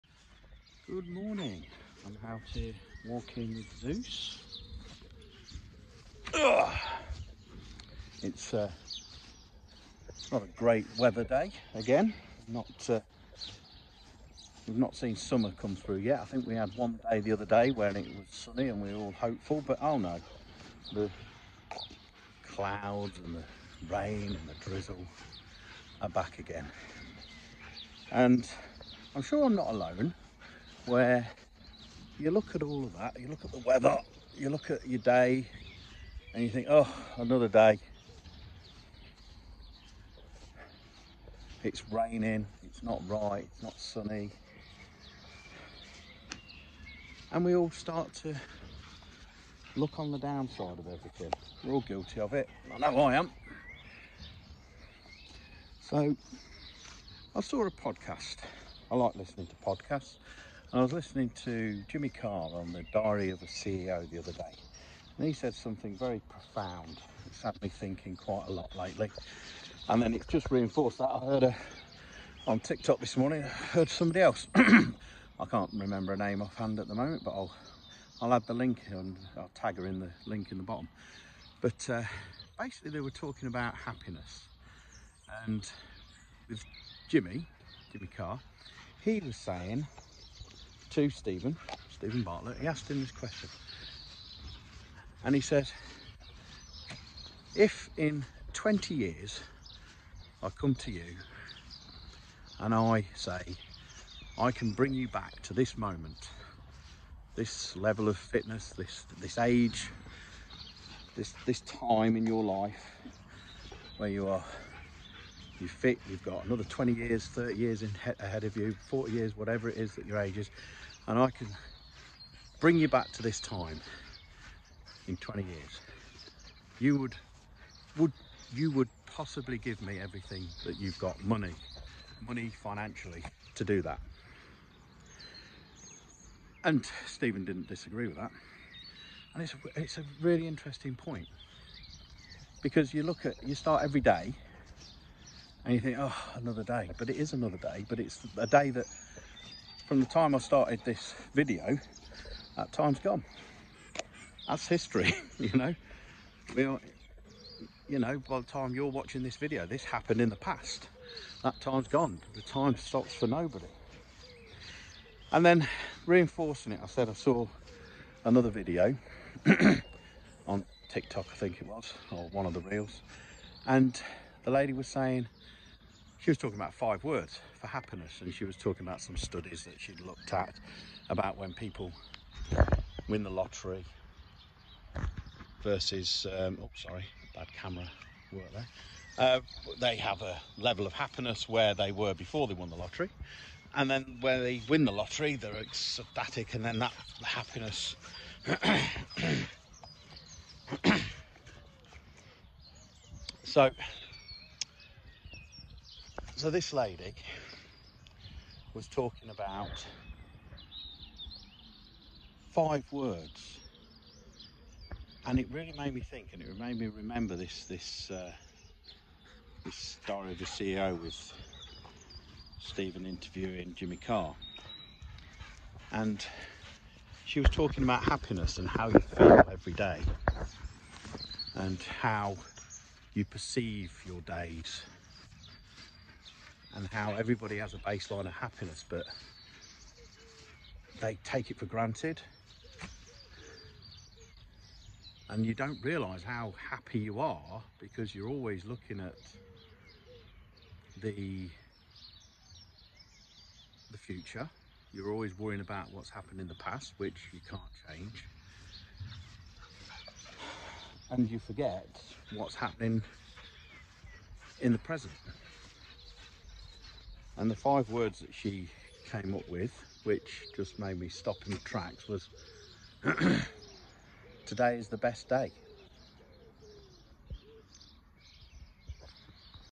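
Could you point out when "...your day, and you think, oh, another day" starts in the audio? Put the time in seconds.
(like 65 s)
34 s.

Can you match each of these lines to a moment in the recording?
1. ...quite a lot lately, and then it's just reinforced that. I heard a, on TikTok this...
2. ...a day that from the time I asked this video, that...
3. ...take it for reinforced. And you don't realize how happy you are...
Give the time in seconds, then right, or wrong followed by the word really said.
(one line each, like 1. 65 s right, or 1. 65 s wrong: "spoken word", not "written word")
1. 68 s right
2. 148 s wrong: "started", not "asked"
3. 241 s wrong: "granted", not "reinforced".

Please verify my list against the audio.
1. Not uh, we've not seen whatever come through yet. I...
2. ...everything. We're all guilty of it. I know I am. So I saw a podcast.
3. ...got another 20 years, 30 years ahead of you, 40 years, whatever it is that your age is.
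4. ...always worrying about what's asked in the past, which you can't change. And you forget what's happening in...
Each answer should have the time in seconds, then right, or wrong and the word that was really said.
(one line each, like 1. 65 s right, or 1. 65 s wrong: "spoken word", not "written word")
1. 12 s wrong: "summer", not "whatever"
2. 50 s right
3. 116 s right
4. 255 s wrong: "happened", not "asked".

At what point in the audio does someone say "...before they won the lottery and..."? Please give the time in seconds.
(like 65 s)
192 s.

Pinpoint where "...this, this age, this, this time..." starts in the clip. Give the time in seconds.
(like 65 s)
108 s.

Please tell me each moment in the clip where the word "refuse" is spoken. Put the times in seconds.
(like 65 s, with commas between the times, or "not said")
not said.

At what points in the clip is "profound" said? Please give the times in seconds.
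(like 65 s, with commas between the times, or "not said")
66 s.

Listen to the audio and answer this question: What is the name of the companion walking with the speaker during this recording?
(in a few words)
Zeus.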